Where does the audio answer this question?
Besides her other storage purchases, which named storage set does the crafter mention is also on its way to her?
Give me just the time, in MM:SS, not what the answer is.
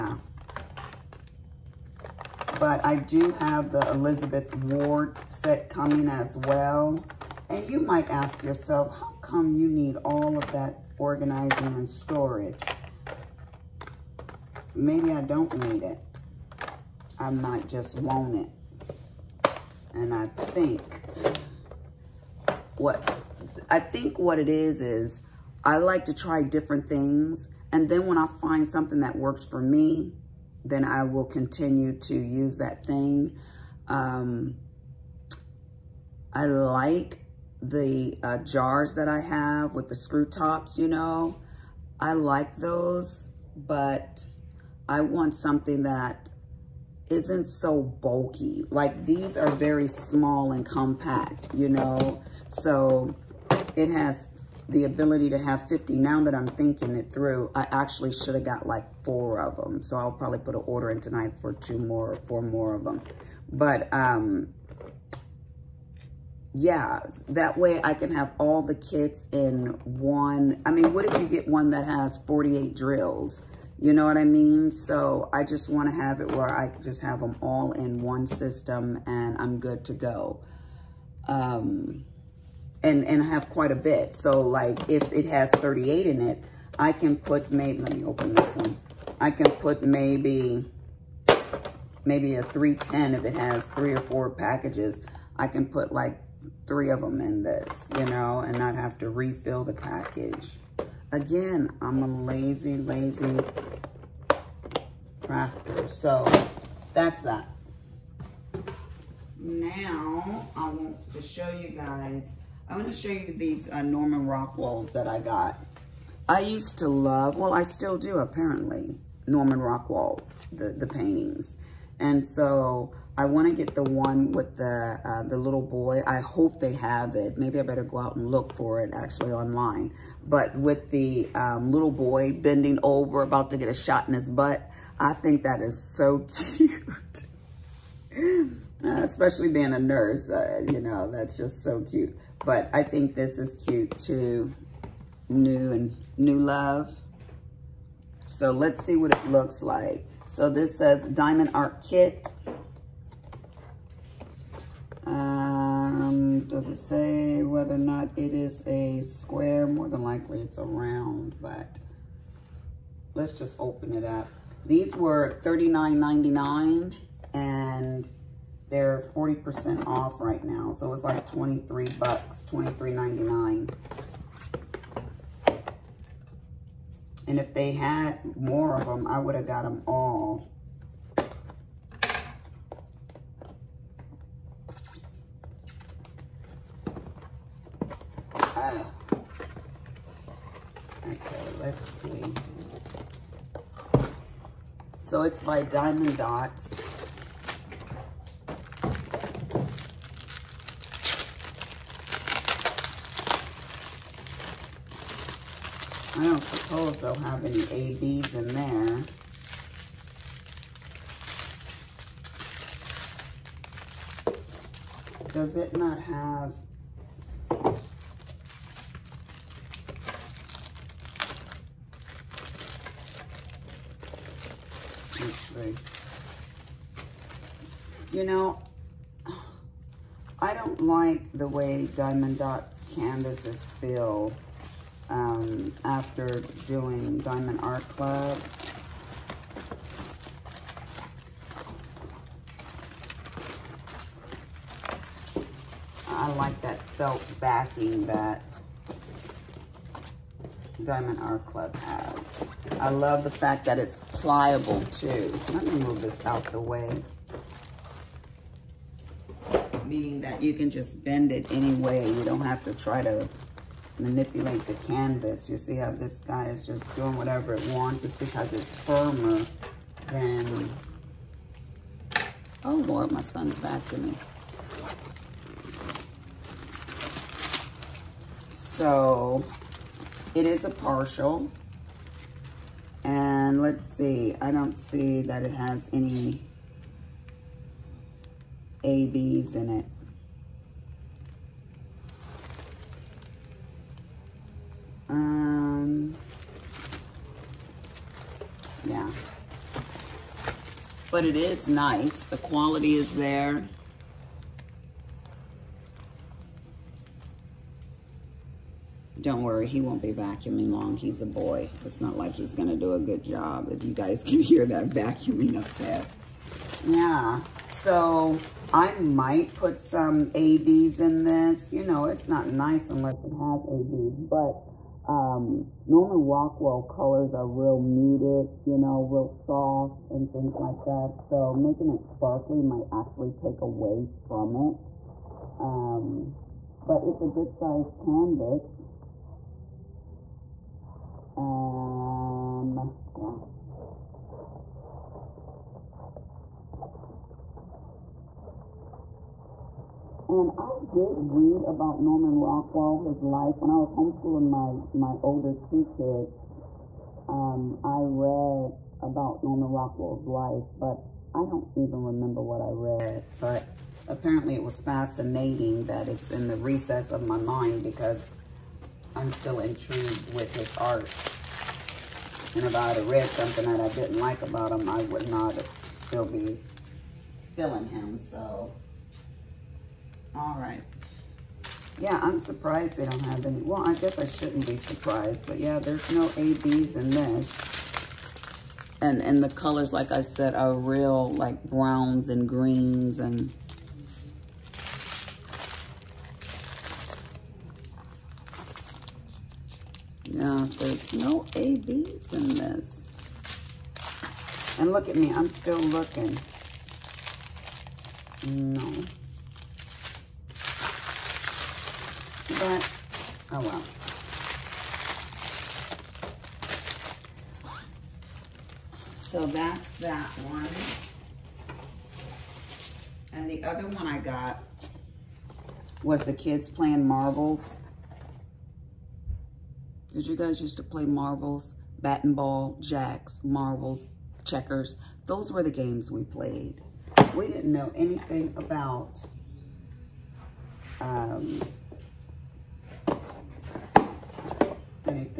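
00:03.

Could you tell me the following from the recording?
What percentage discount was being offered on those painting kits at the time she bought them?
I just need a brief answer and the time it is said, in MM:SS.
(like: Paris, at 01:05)
40%, at 02:49.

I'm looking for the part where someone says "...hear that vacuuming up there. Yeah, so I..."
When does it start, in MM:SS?
05:14.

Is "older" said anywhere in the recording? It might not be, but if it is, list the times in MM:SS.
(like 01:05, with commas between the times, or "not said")
05:55.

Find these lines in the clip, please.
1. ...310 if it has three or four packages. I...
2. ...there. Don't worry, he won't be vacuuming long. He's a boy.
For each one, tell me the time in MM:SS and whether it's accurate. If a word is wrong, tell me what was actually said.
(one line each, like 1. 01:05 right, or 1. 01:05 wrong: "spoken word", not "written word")
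1. 01:32 right
2. 05:03 right.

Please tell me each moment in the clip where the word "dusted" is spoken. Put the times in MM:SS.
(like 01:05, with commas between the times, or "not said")
not said.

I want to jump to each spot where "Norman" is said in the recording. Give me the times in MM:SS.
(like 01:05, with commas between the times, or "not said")
01:53, 01:59, 05:25, 05:52, 05:59.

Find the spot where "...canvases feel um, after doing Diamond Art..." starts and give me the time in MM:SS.
03:52.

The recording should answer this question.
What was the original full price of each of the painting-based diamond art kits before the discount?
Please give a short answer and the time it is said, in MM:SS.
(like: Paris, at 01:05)
$39.99, at 02:45.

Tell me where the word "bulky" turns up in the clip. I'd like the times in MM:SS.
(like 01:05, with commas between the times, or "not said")
00:47.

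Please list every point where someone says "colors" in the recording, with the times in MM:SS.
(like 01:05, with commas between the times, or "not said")
05:26, 06:29.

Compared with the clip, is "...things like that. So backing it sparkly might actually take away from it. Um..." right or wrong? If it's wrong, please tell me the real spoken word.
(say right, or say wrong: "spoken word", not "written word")
wrong: "making", not "backing".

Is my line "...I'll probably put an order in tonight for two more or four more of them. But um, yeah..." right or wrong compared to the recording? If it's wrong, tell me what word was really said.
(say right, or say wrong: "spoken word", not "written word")
right.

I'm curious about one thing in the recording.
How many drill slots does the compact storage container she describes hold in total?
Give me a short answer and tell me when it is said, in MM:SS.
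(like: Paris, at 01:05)
50, at 00:55.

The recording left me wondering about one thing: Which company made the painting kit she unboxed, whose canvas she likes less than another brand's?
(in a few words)
Diamond Dots.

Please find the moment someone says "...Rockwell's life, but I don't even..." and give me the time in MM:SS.
05:59.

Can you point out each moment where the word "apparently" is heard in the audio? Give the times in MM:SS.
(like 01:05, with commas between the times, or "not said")
01:58, 06:04.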